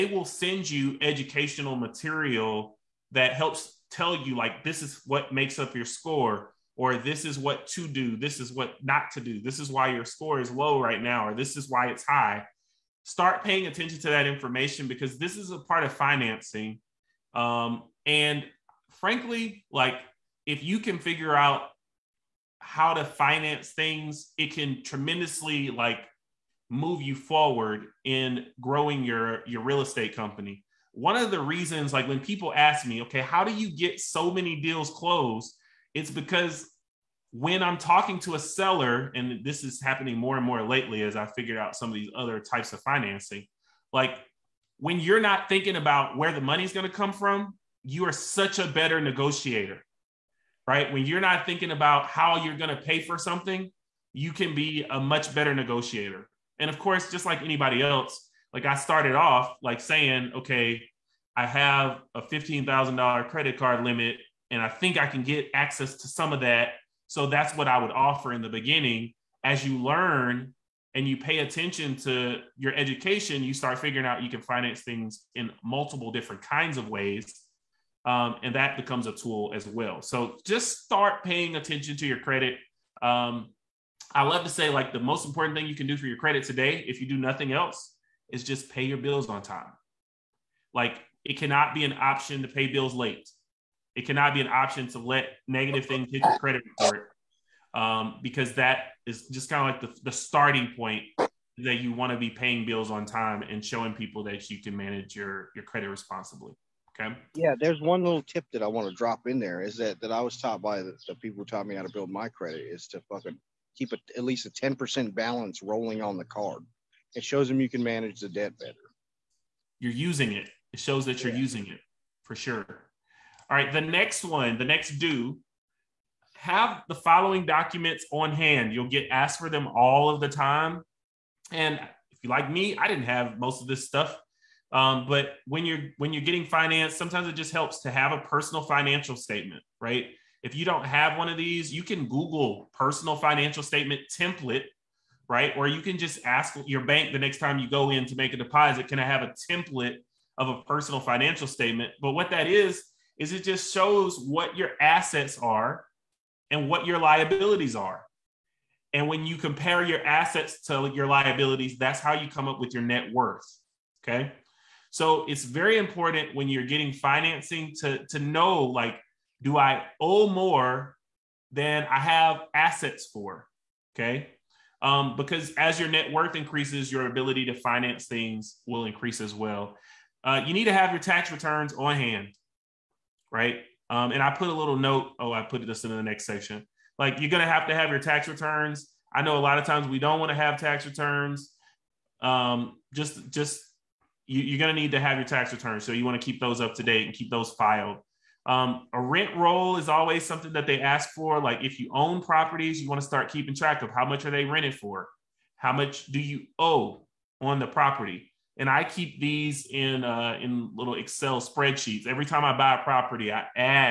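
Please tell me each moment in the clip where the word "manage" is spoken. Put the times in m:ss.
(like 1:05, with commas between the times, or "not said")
1:44, 1:57.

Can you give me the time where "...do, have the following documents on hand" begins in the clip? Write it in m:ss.
2:04.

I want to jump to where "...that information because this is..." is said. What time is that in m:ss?
0:14.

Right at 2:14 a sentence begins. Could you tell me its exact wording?
Um, but when you're when you're getting finance, sometimes it just helps to have a personal financial statement, right?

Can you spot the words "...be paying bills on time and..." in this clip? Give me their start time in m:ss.
1:42.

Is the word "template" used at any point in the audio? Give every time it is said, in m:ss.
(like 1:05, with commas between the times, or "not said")
2:24, 2:29.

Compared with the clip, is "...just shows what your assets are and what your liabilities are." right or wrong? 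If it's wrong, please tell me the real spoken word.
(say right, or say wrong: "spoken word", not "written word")
right.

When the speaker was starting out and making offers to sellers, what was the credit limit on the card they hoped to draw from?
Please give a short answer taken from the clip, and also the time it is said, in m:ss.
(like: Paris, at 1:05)
$15,000, at 1:02.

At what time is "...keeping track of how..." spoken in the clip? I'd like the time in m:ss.
3:23.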